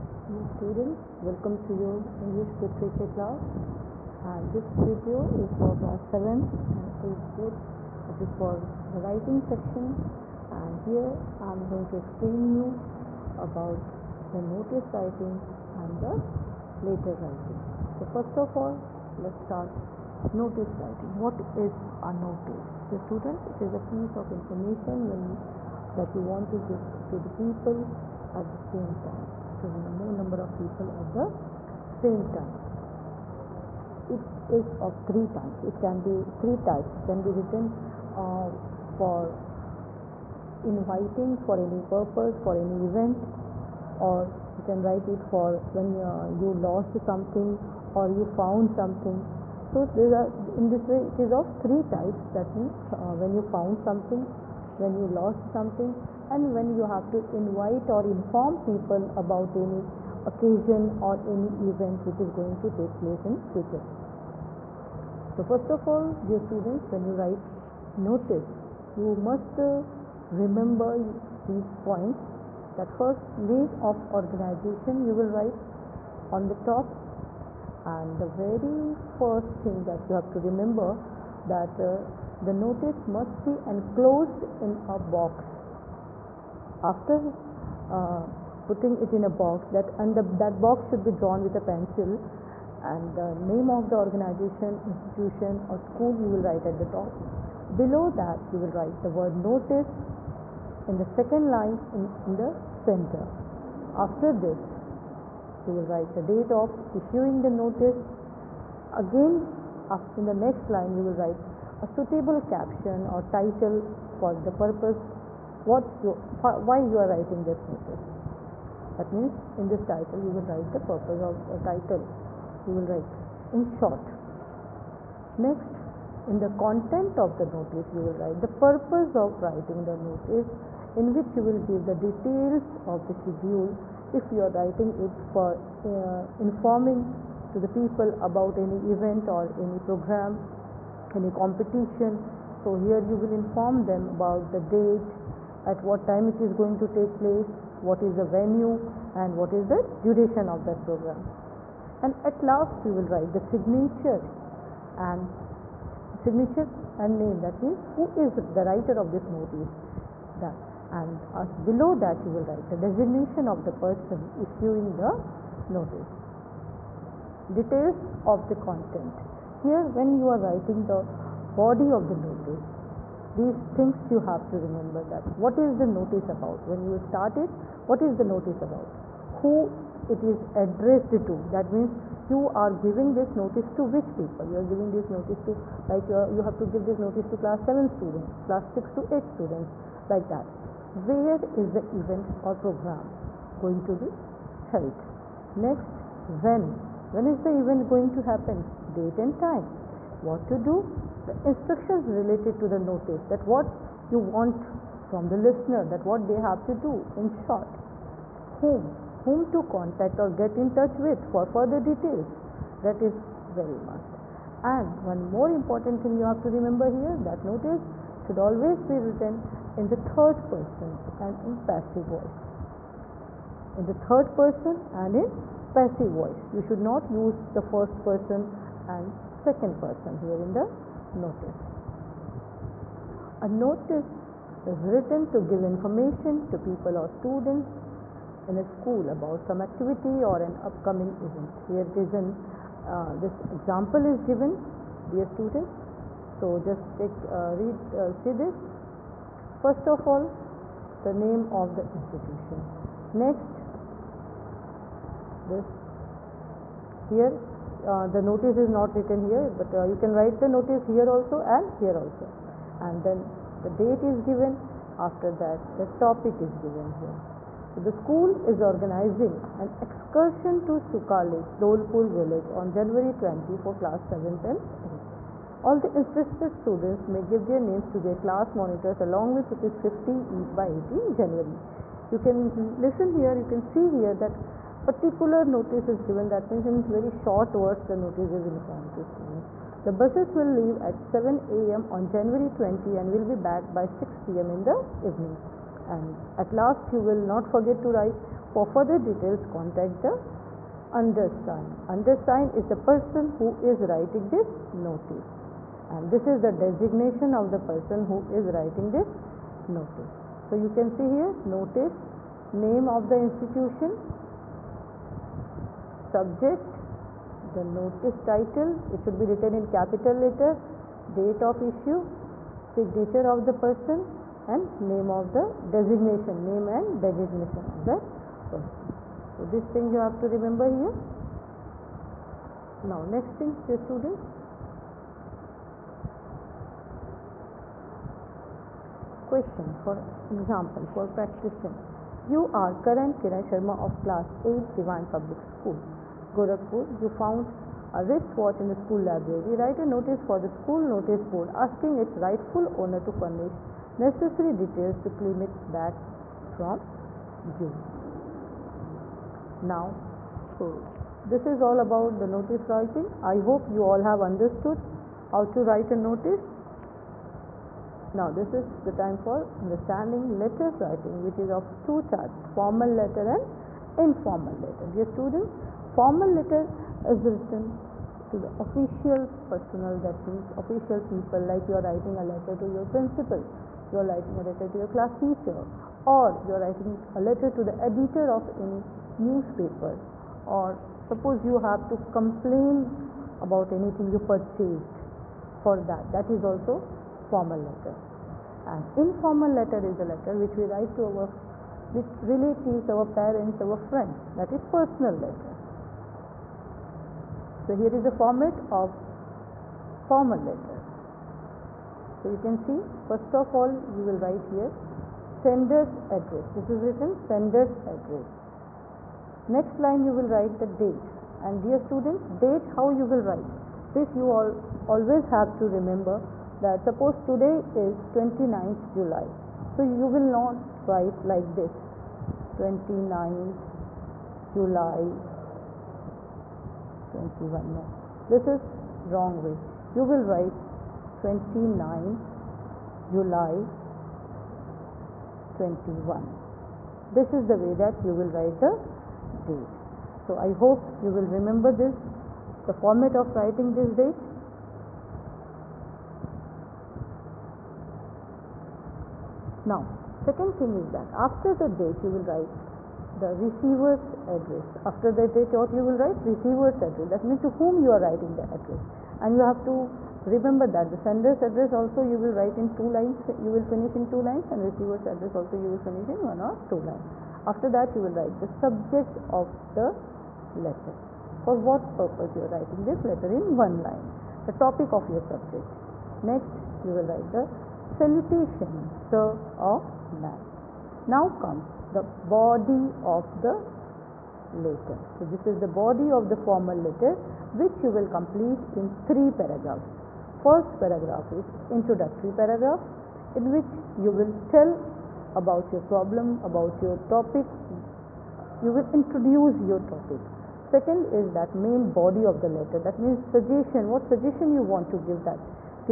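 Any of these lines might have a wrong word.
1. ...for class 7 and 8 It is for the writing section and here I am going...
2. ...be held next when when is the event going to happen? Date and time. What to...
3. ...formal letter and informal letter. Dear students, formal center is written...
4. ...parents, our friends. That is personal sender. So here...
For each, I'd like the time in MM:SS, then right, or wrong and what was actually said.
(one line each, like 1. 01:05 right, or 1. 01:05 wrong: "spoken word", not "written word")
1. 00:05 right
2. 03:14 right
3. 06:12 wrong: "letter", not "center"
4. 06:43 wrong: "letter", not "sender".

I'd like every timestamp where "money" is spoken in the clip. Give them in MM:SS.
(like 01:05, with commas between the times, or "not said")
not said.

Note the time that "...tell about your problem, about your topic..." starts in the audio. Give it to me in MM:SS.
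08:24.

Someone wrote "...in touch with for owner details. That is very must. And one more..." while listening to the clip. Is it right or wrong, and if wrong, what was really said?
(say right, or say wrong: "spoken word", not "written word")
wrong: "further", not "owner".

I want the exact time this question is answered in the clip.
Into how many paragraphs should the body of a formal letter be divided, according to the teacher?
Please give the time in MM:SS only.
08:19.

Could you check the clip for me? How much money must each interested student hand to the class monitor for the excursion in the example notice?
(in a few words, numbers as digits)
Rupees 50.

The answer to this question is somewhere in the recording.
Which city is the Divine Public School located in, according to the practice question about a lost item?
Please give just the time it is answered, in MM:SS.
05:46.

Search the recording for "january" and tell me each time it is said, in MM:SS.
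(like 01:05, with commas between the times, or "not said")
04:32, 04:41, 04:52.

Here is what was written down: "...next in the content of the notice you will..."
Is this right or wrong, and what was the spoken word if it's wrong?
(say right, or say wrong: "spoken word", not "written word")
right.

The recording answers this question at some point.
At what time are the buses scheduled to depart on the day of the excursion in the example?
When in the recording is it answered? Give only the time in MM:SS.
04:51.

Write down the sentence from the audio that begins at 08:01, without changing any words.
For what purpose you are writing this letter in one line.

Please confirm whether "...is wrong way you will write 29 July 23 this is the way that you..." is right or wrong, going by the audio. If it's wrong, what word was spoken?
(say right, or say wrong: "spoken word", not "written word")
wrong: "21", not "23".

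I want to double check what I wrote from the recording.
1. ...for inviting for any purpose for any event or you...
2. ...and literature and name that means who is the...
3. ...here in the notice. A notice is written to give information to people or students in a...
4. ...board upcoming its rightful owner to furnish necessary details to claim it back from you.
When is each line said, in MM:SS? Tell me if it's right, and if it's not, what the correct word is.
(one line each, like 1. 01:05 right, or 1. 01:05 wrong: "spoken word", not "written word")
1. 00:38 right
2. 02:35 wrong: "signature", not "literature"
3. 03:50 right
4. 05:51 wrong: "asking", not "upcoming".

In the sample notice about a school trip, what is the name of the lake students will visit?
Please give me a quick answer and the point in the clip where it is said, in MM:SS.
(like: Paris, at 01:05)
Suka Lake, at 04:30.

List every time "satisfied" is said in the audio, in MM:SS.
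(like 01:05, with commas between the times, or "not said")
not said.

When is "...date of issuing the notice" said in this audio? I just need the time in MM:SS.
01:46.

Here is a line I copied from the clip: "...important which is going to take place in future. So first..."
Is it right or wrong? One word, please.
wrong.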